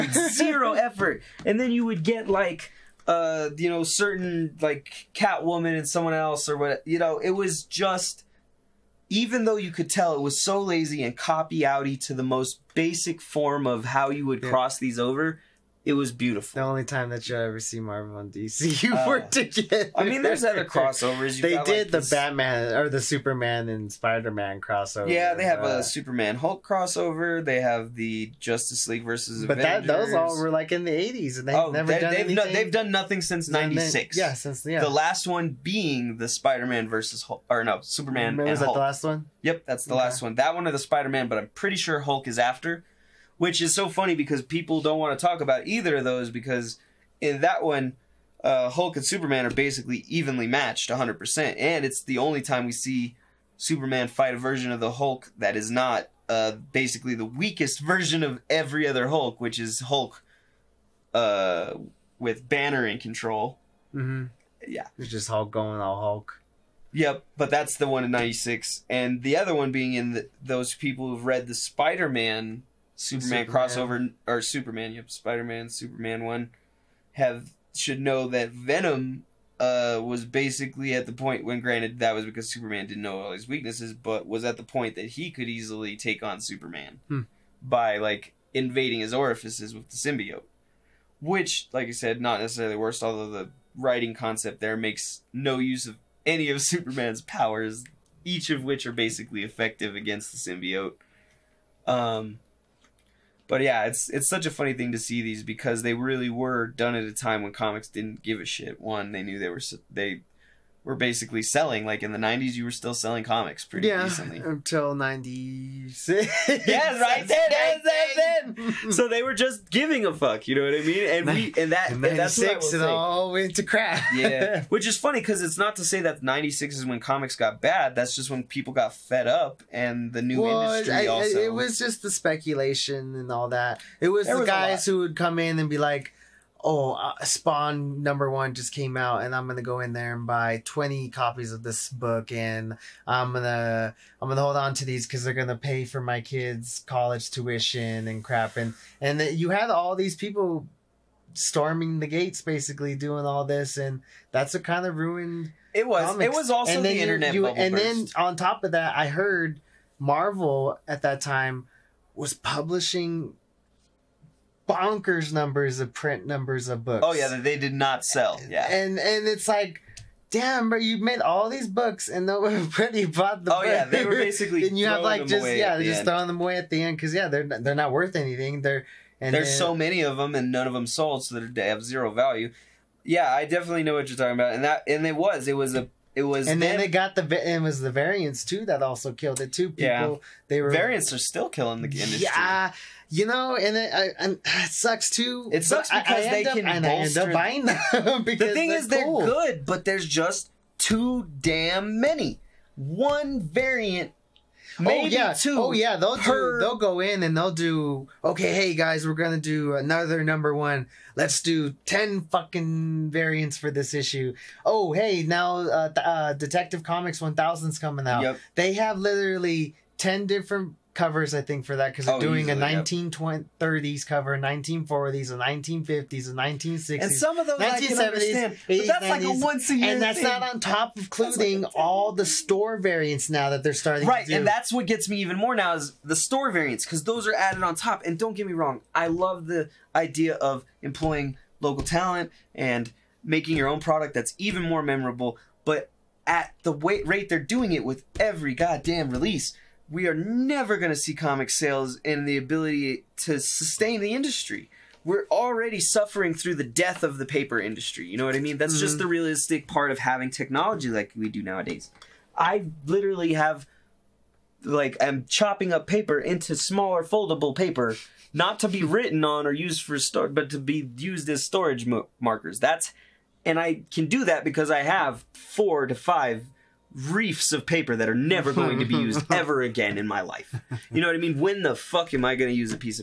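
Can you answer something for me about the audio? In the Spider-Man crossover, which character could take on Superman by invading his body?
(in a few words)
Venom.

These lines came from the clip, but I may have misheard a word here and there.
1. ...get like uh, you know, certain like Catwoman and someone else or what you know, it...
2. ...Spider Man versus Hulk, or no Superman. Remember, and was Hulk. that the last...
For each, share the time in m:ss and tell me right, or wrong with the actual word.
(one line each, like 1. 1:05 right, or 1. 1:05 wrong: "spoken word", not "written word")
1. 0:02 right
2. 0:36 right.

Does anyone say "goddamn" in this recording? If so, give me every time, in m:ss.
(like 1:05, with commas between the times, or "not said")
4:08.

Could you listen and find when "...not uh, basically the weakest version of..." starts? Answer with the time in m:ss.
0:55.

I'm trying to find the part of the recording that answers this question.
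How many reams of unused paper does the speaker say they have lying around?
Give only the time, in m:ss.
4:35.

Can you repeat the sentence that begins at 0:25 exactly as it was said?
Yeah, they have uh, a Superman Hulk crossover.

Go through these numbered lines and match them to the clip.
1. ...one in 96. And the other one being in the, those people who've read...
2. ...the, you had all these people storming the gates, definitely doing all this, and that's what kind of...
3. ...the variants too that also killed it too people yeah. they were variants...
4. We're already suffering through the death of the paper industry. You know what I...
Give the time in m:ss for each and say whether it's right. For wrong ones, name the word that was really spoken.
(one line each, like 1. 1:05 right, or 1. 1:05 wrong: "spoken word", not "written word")
1. 1:07 right
2. 2:29 wrong: "basically", not "definitely"
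3. 3:07 right
4. 4:15 right.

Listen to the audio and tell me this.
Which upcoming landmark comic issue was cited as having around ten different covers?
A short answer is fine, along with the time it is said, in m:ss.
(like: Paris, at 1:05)
Detective Comics 1000, at 3:36.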